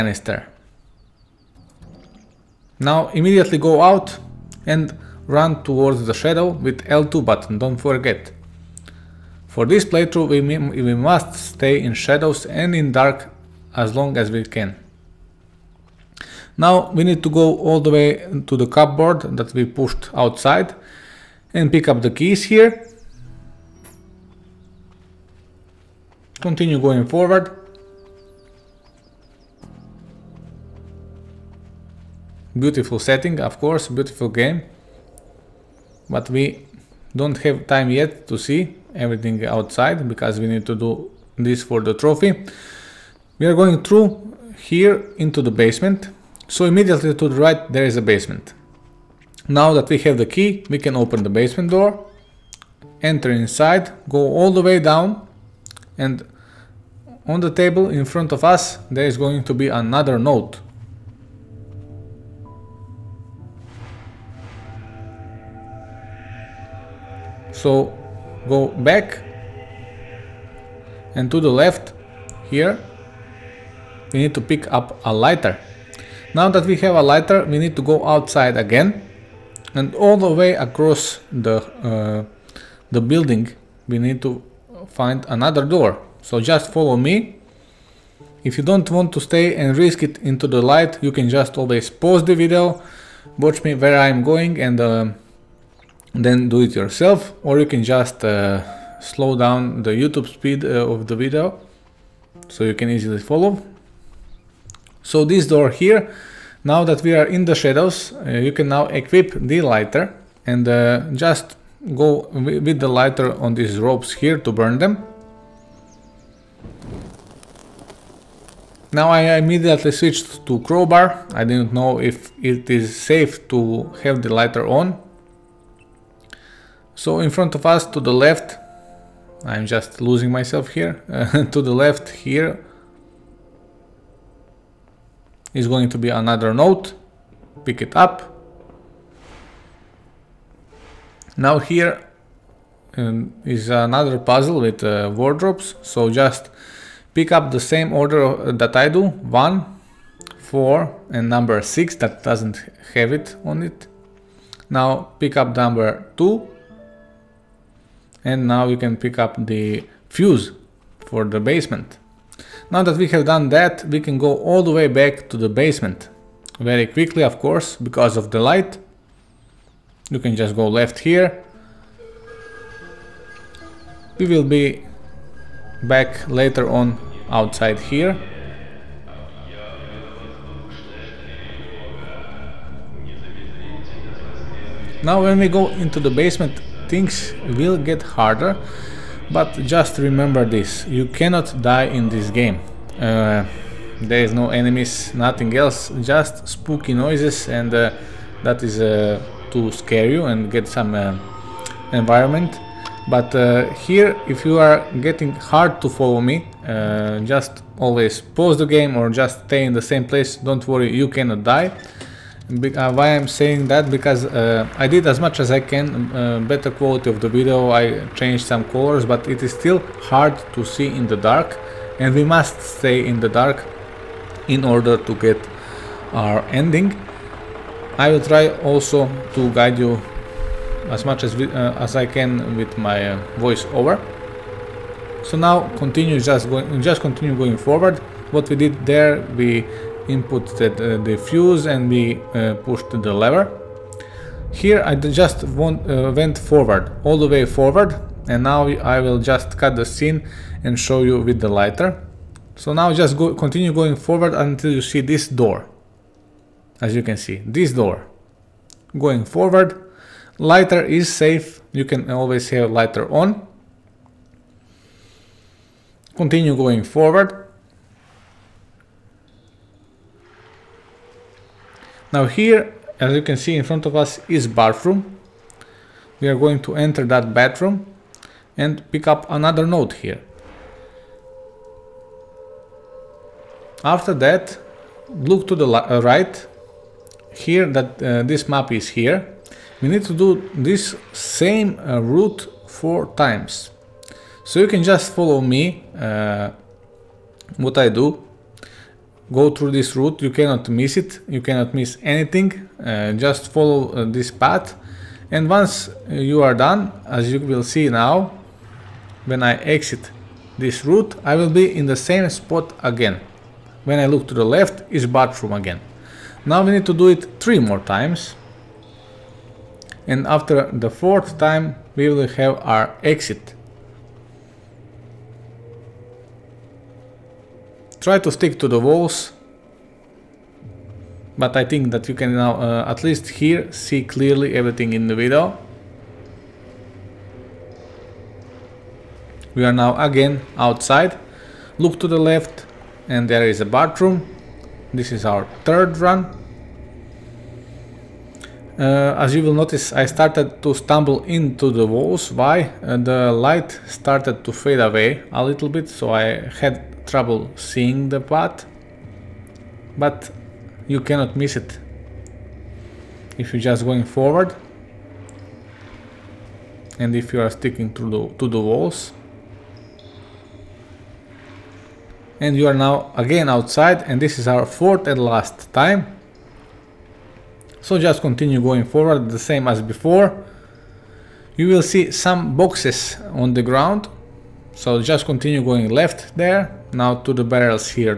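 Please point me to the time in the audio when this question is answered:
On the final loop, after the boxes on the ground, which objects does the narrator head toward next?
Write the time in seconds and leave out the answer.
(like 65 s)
387 s.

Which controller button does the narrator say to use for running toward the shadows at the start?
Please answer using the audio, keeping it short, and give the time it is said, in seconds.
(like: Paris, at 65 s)
L2, at 6 s.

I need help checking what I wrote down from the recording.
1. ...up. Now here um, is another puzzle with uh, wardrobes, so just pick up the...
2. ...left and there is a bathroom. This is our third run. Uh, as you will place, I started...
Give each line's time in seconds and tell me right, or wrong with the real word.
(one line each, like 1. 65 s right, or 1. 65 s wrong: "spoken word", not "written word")
1. 137 s right
2. 342 s wrong: "notice", not "place".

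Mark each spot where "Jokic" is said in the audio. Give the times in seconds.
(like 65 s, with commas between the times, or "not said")
not said.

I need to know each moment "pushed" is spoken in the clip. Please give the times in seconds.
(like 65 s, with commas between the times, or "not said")
19 s, 242 s.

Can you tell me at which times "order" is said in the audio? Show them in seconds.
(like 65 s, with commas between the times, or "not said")
147 s, 224 s.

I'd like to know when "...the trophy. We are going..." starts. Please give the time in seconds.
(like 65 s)
41 s.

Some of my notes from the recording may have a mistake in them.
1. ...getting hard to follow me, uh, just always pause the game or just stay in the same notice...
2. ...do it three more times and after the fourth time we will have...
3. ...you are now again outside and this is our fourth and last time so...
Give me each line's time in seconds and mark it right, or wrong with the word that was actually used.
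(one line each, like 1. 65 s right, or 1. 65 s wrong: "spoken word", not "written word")
1. 205 s wrong: "place", not "notice"
2. 316 s right
3. 372 s right.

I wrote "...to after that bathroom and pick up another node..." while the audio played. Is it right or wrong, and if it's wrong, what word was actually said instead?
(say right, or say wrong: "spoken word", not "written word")
wrong: "enter", not "after".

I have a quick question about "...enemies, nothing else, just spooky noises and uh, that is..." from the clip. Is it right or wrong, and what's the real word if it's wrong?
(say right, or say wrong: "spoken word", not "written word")
right.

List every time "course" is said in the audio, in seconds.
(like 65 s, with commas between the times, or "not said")
33 s, 167 s.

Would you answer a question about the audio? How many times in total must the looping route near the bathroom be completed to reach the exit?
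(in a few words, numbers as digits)
4.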